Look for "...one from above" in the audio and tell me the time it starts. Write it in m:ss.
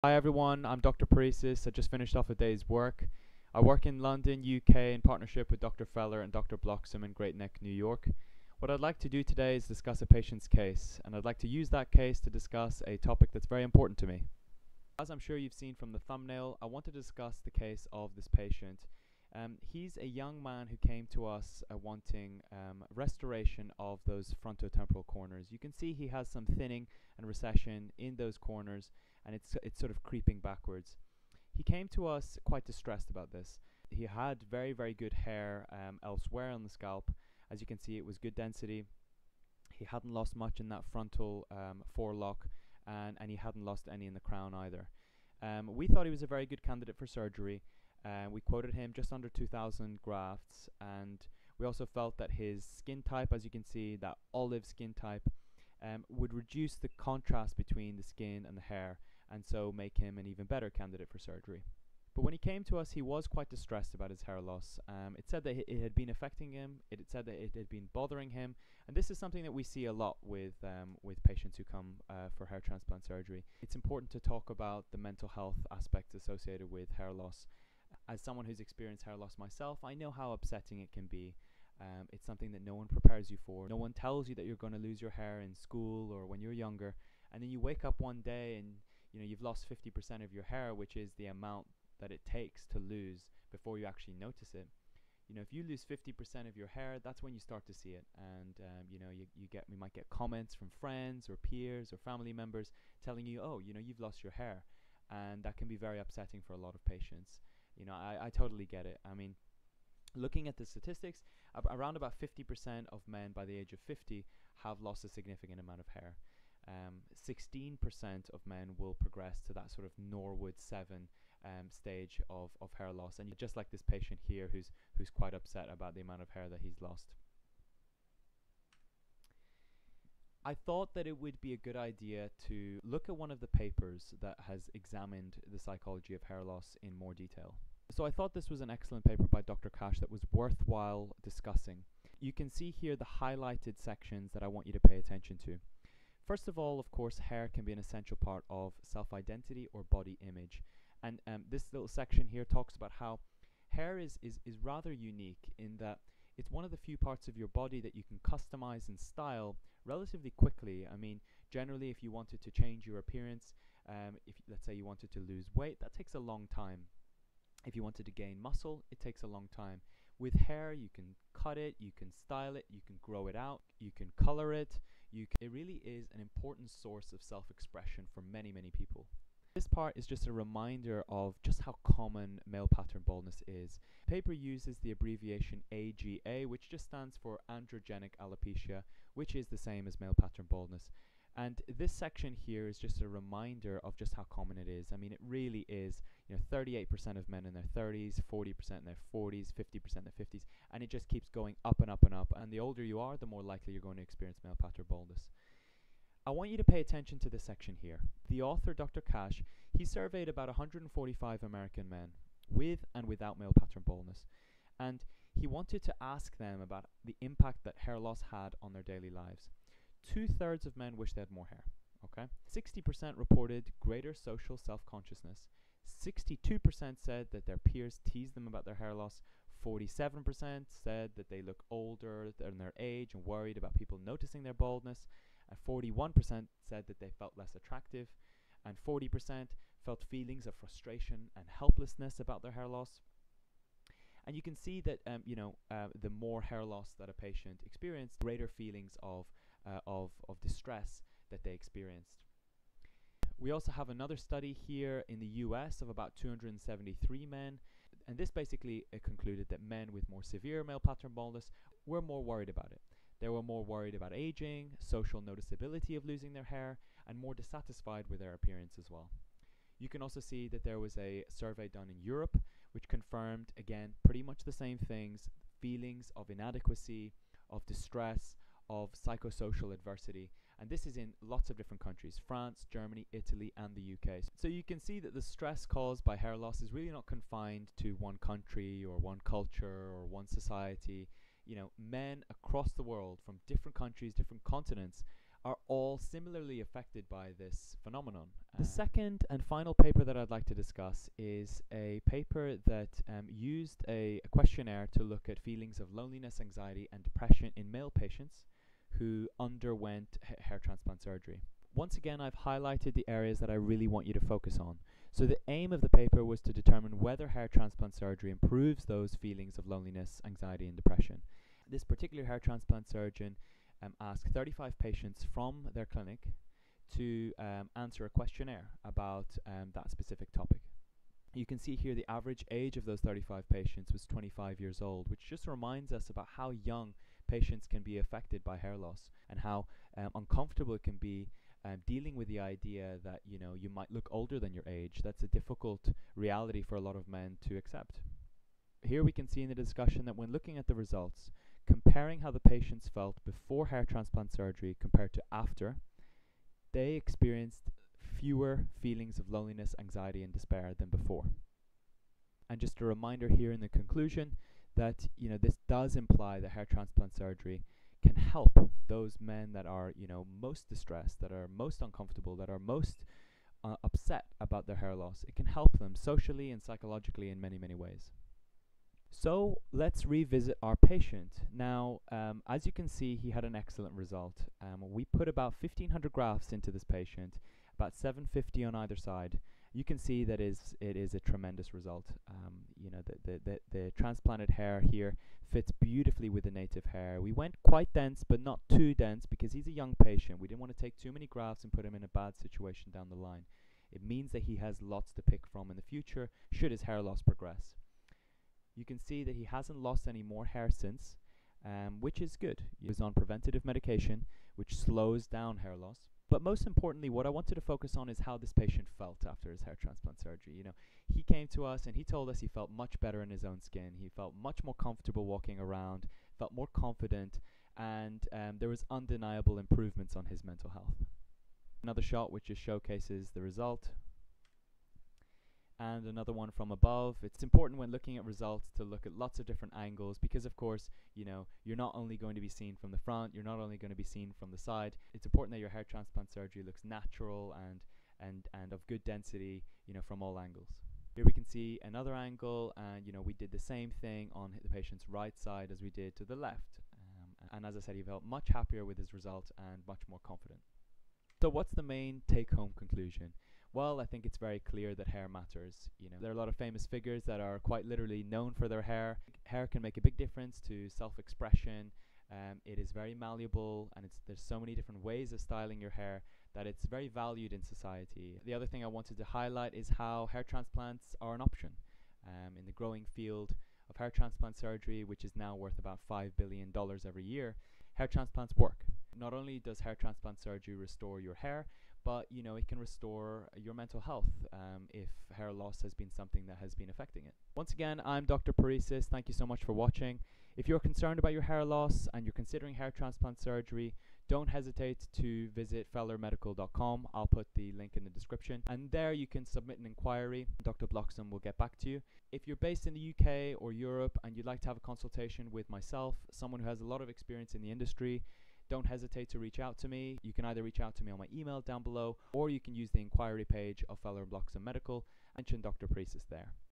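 7:16.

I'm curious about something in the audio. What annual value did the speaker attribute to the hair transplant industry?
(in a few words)
$5 billion.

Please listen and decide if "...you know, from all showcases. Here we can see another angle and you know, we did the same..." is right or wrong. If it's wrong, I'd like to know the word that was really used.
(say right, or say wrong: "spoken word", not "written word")
wrong: "angles", not "showcases".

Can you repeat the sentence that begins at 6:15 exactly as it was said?
It can help them socially and psychologically in many many ways.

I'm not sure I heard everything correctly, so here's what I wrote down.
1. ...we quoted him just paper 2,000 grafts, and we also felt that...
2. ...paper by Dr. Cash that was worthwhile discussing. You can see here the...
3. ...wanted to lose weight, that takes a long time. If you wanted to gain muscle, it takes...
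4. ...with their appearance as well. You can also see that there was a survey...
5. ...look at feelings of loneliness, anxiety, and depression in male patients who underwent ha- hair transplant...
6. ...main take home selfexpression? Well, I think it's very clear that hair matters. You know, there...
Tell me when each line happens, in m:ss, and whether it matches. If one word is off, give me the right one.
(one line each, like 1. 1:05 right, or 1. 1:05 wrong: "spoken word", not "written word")
1. 0:48 wrong: "under", not "paper"
2. 2:19 right
3. 2:44 right
4. 4:28 right
5. 5:05 right
6. 7:41 wrong: "conclusion", not "selfexpression".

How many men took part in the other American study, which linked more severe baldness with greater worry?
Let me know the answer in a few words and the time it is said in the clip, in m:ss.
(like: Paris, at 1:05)
273, at 4:16.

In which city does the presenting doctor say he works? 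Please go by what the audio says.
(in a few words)
London.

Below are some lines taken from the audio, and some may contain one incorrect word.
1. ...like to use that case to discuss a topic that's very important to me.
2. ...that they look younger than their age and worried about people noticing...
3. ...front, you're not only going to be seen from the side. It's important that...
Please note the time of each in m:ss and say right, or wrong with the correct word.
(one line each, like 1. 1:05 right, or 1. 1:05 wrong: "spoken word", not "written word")
1. 0:11 right
2. 3:51 wrong: "older", not "younger"
3. 7:22 right.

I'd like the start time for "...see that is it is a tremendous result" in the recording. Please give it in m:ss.
6:29.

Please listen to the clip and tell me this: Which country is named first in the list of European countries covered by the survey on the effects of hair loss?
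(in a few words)
France.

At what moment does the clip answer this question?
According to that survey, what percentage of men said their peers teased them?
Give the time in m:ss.
3:46.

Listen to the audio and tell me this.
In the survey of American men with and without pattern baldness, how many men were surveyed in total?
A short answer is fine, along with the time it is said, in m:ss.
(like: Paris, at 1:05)
145, at 3:30.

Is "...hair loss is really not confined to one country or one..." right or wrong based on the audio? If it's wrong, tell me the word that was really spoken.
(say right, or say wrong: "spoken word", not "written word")
right.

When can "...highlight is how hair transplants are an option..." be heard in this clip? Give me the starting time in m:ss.
7:59.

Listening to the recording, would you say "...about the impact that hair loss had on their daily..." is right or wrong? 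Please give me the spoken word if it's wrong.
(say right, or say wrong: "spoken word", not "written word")
right.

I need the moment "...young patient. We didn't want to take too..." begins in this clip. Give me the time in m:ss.
6:39.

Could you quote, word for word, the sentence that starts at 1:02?
But when he came to us, he was quite distressed about his hair loss.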